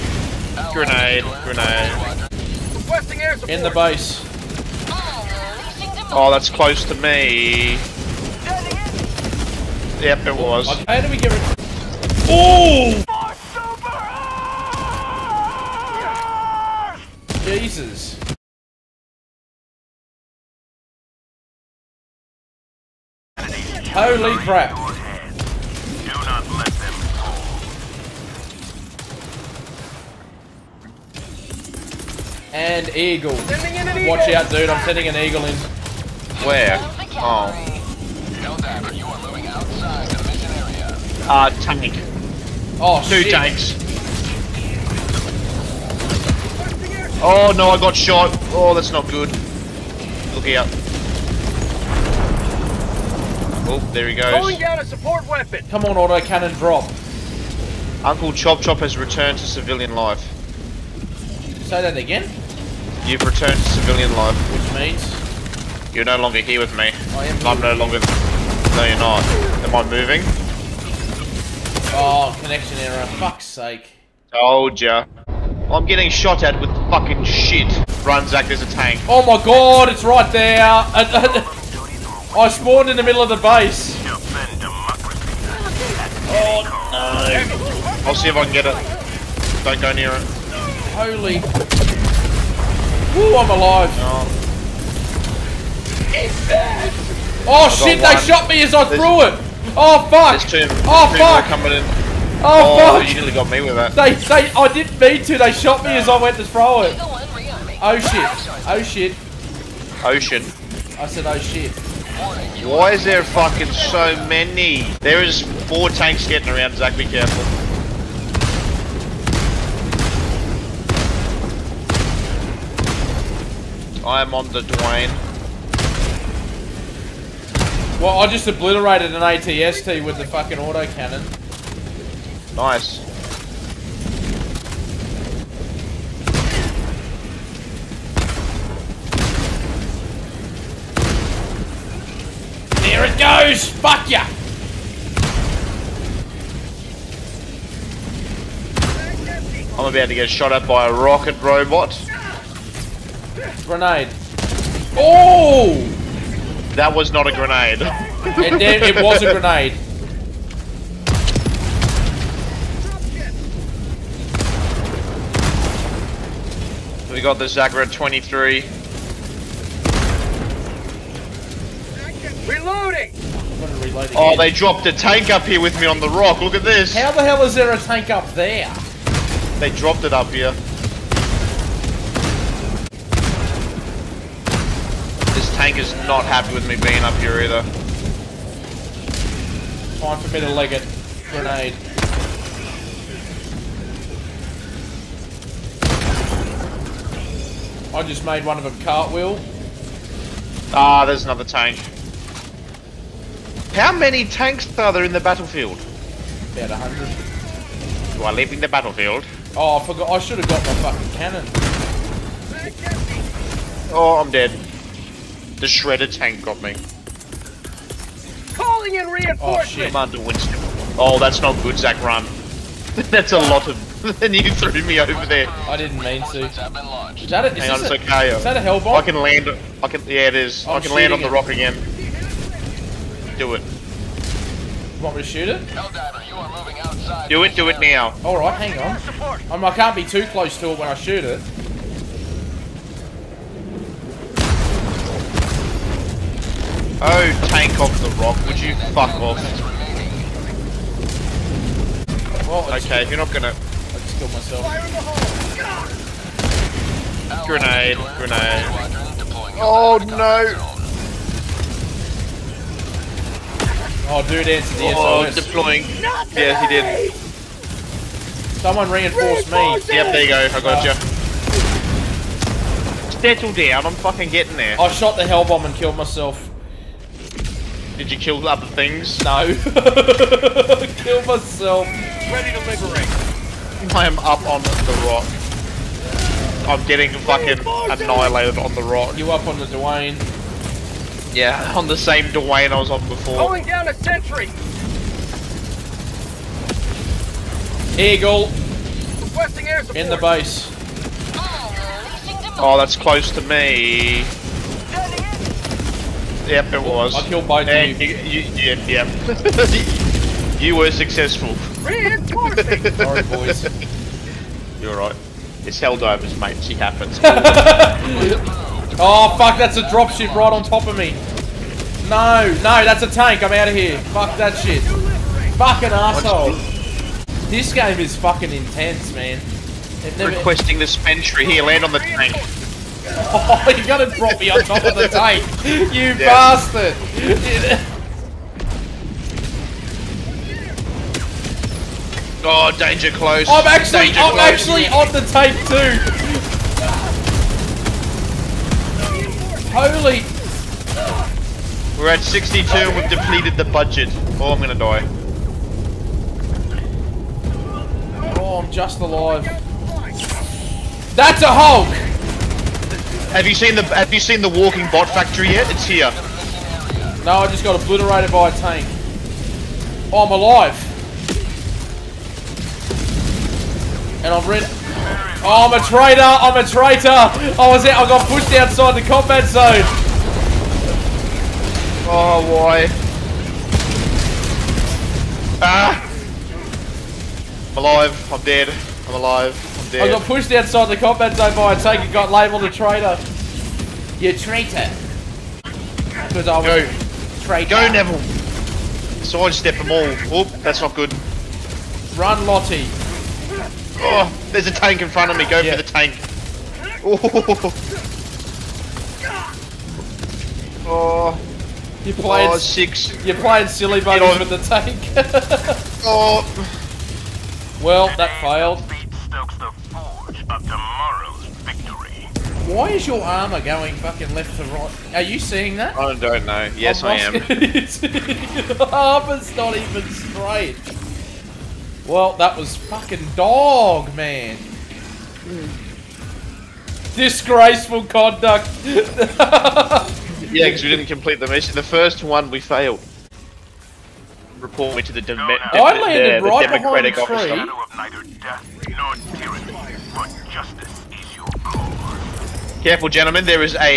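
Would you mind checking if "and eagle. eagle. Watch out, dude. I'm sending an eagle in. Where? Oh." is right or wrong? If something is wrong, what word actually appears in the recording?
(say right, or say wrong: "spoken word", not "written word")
right.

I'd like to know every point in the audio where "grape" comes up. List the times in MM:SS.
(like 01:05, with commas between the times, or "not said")
not said.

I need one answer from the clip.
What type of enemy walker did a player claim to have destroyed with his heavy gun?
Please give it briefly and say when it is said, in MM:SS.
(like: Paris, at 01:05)
ATST, at 02:09.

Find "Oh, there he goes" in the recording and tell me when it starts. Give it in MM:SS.
00:53.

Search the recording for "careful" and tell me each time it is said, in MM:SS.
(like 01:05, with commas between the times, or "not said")
01:57, 07:32.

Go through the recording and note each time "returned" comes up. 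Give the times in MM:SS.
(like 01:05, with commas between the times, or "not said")
00:58, 01:03.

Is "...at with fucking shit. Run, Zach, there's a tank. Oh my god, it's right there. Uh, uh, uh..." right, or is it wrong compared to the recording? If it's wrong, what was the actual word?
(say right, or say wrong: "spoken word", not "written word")
right.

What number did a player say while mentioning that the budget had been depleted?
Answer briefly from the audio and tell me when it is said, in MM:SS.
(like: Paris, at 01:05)
62, at 05:52.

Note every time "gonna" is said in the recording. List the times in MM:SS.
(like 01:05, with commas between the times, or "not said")
04:13, 05:54.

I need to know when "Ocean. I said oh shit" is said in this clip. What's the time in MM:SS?
01:50.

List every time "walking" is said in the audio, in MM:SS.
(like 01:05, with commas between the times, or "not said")
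06:04.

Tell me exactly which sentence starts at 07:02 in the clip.
Why is your armor going fucking left to right?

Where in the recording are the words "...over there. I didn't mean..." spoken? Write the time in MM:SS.
03:44.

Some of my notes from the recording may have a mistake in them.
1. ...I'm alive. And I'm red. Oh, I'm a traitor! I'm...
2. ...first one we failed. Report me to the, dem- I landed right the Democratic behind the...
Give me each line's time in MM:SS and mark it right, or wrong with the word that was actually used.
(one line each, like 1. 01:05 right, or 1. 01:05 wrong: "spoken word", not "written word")
1. 06:10 right
2. 07:21 right.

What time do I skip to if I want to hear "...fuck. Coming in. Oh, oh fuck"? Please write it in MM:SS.
01:41.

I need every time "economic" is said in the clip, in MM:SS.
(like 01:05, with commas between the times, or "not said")
not said.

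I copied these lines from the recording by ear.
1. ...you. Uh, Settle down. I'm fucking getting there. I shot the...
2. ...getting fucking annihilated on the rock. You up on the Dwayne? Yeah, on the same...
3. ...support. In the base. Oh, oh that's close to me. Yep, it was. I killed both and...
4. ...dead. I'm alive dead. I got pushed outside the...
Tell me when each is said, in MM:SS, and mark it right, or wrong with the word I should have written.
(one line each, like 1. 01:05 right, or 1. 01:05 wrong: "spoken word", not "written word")
1. 04:30 right
2. 04:46 right
3. 04:59 right
4. 06:28 right.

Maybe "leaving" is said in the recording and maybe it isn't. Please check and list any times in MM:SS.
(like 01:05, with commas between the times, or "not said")
03:28.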